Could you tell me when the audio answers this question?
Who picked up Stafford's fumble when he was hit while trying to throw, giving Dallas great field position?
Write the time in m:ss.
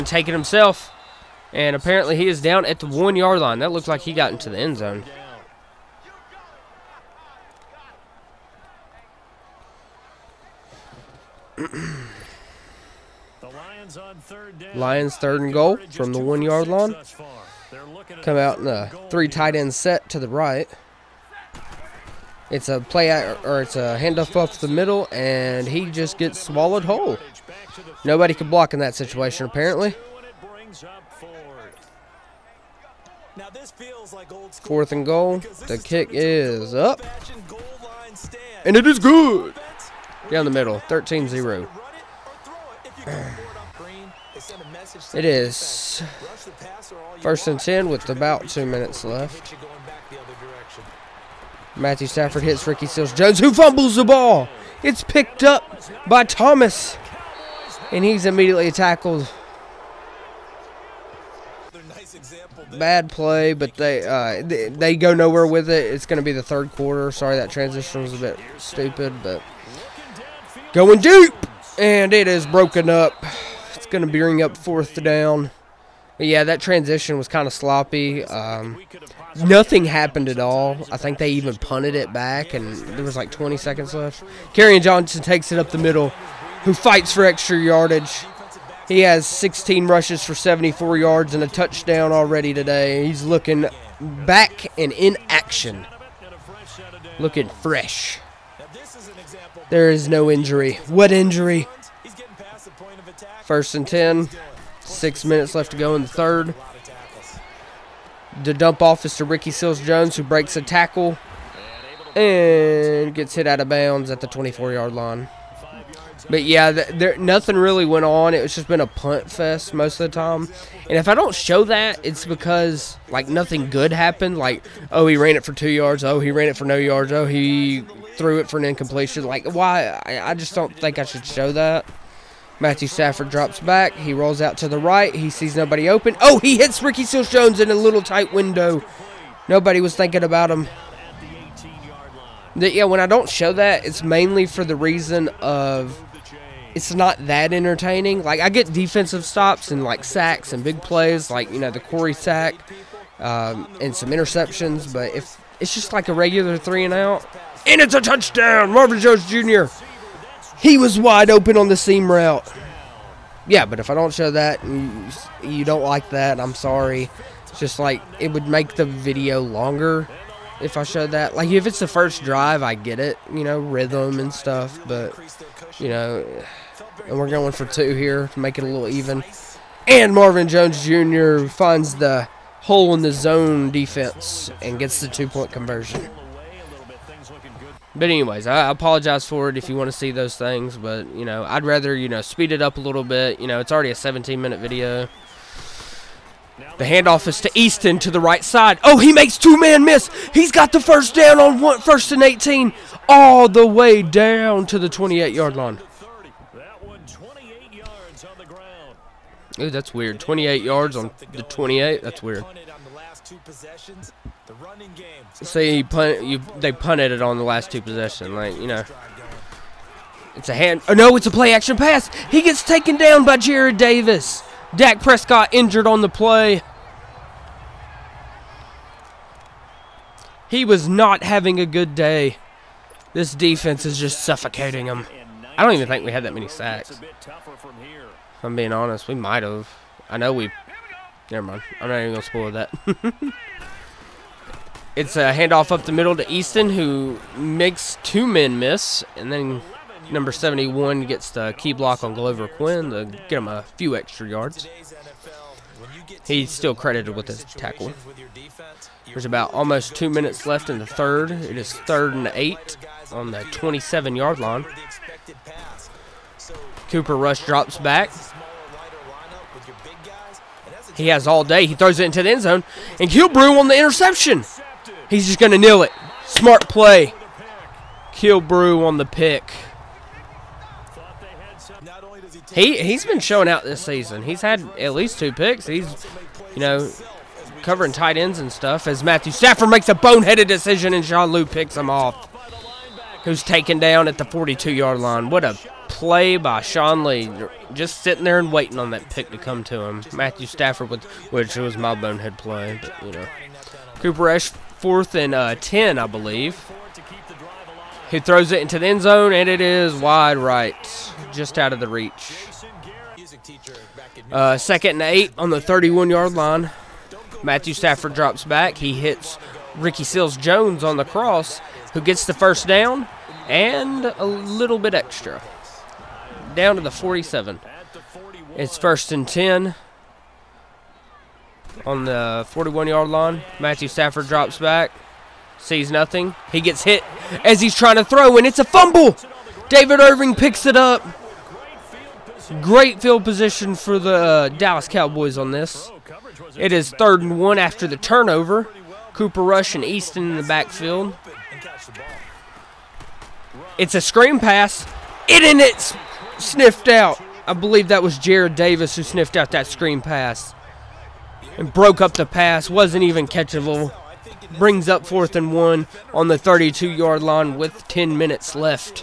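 5:39.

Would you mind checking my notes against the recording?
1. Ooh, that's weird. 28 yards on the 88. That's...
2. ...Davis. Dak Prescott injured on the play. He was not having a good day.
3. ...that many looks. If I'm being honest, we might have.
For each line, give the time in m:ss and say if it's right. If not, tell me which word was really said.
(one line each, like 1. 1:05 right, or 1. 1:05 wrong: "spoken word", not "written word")
1. 3:29 wrong: "28", not "88"
2. 3:43 right
3. 3:56 wrong: "sacks", not "looks".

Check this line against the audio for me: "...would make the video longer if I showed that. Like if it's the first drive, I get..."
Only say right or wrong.
right.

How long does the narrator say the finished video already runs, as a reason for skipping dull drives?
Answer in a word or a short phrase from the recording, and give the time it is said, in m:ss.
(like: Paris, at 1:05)
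17 minutes, at 3:13.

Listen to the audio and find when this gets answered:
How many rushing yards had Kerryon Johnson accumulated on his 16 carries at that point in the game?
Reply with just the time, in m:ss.
1:30.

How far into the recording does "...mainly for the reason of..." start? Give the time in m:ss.
2:24.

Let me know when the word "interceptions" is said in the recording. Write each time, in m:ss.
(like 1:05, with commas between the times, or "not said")
2:34, 4:33.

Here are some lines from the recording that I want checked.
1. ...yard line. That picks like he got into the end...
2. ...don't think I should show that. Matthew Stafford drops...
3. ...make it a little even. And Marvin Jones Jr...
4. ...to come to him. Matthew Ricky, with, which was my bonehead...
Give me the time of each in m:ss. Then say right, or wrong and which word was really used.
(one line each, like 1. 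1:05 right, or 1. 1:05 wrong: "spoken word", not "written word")
1. 0:03 wrong: "looks", not "picks"
2. 2:10 right
3. 2:58 right
4. 4:59 wrong: "Stafford", not "Ricky".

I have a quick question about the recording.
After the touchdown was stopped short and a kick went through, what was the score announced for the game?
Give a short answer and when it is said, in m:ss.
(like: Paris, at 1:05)
13-0, at 0:40.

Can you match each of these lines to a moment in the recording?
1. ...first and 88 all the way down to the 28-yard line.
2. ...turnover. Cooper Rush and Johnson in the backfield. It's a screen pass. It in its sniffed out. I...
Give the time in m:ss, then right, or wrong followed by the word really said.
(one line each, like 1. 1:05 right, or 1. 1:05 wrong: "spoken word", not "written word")
1. 3:21 wrong: "18", not "88"
2. 5:47 wrong: "Easton", not "Johnson".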